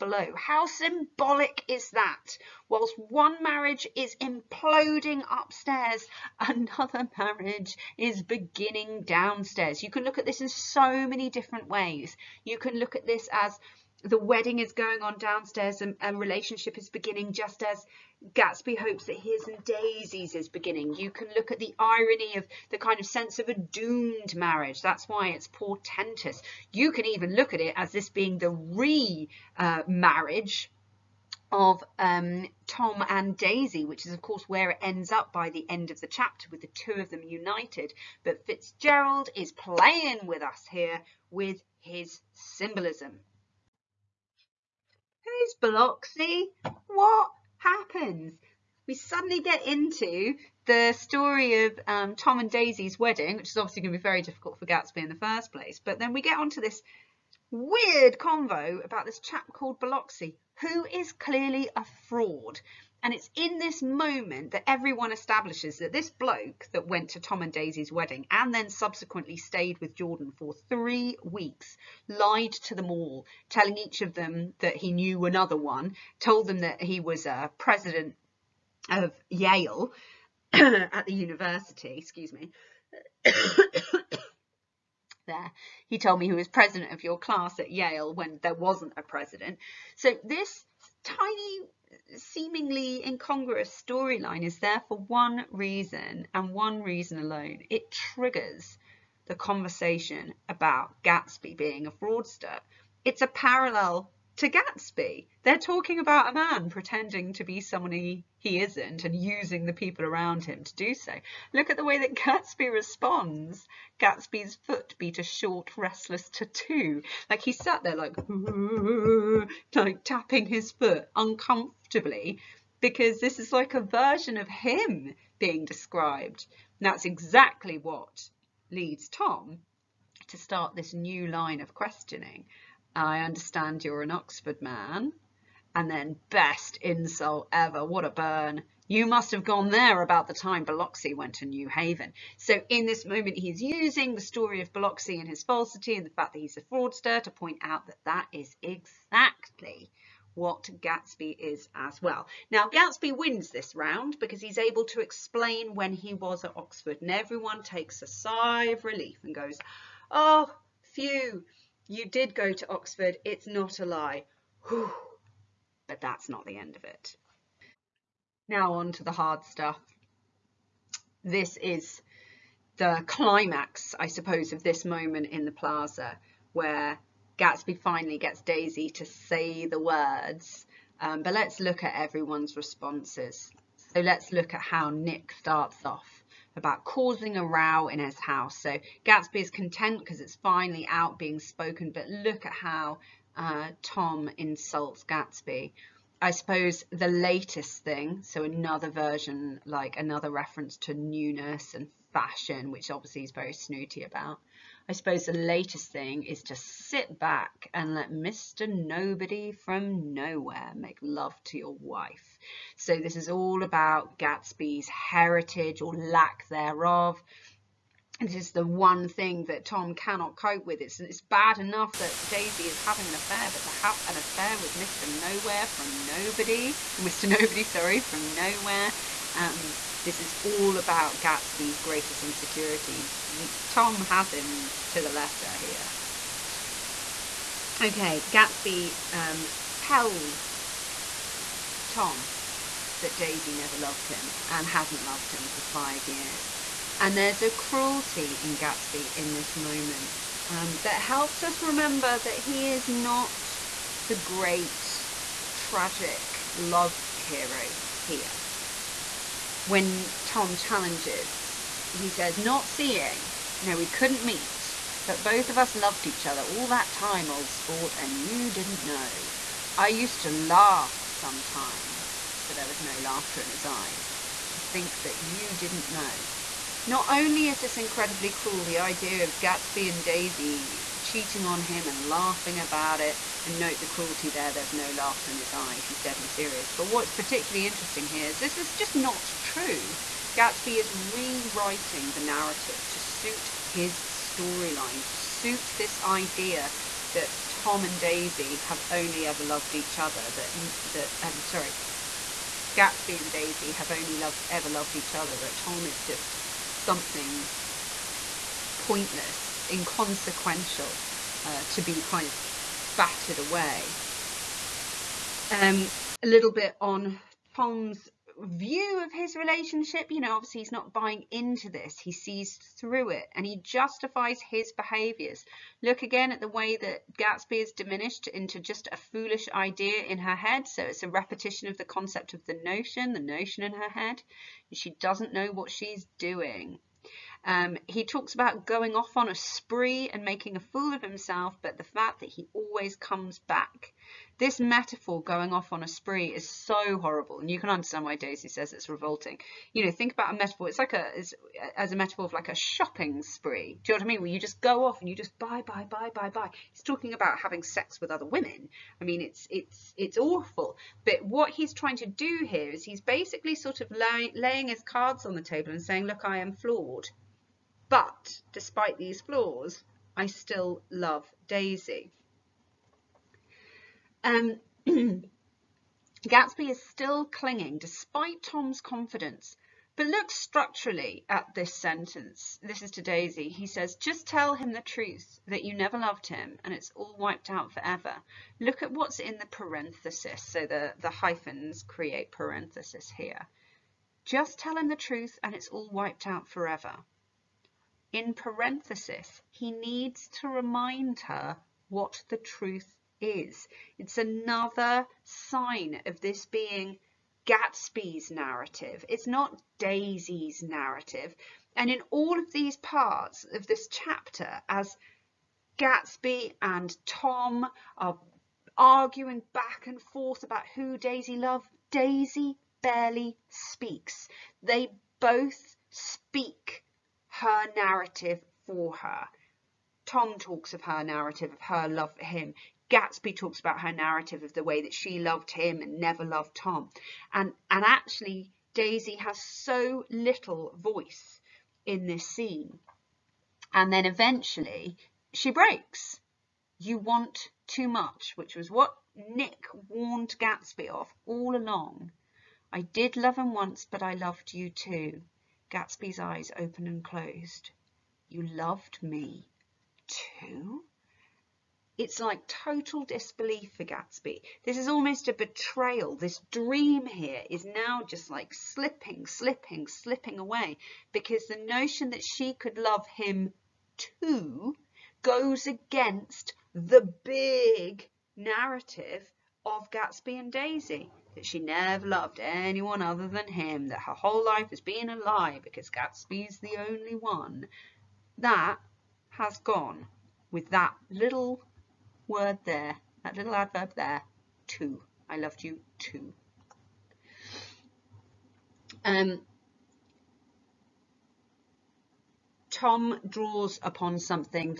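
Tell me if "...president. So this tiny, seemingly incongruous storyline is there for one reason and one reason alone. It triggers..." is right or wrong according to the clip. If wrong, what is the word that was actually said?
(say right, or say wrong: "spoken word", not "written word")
right.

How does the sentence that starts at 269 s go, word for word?
I used to laugh sometimes, but there was no laughter in his eyes.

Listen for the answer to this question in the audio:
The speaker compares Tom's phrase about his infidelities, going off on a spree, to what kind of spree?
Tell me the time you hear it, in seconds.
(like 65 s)
352 s.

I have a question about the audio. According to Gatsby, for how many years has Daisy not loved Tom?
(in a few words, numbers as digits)
5 years.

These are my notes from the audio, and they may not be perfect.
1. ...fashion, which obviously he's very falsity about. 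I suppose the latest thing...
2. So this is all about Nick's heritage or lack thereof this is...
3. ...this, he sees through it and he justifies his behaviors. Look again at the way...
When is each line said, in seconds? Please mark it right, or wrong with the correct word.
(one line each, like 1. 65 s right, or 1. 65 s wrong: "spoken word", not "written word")
1. 202 s wrong: "snooty", not "falsity"
2. 212 s wrong: "Gatsby", not "Nick"
3. 321 s right.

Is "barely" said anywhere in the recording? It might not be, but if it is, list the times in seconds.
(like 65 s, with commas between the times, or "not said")
422 s.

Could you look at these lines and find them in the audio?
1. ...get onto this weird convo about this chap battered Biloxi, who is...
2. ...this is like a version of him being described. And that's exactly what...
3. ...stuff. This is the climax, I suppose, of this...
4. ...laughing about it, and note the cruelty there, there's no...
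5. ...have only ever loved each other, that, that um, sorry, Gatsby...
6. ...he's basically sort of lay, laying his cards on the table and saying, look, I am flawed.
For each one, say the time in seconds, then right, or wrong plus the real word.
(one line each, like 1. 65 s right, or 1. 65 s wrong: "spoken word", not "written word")
1. 56 s wrong: "called", not "battered"
2. 123 s right
3. 169 s right
4. 282 s right
5. 298 s right
6. 362 s right.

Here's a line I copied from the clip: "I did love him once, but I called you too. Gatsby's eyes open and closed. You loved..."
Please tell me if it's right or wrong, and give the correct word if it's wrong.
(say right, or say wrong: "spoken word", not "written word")
wrong: "loved", not "called".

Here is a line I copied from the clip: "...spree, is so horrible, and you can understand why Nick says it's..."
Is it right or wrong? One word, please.
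wrong.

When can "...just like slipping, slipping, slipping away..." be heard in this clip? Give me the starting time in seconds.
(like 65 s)
468 s.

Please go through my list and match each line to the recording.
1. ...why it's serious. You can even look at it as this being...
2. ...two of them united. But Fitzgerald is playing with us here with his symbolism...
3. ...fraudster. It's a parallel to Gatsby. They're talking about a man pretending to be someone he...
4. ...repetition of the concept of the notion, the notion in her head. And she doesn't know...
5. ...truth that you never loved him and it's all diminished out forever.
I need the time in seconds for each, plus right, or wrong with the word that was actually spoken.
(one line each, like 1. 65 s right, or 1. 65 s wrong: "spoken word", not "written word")
1. 25 s wrong: "portentous", not "serious"
2. 36 s right
3. 101 s right
4. 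331 s right
5. 384 s wrong: "wiped", not "diminished".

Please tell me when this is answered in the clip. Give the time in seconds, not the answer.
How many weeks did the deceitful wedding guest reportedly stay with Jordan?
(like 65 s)
70 s.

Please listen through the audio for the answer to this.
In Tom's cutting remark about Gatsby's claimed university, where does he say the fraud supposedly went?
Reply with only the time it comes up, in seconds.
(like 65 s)
141 s.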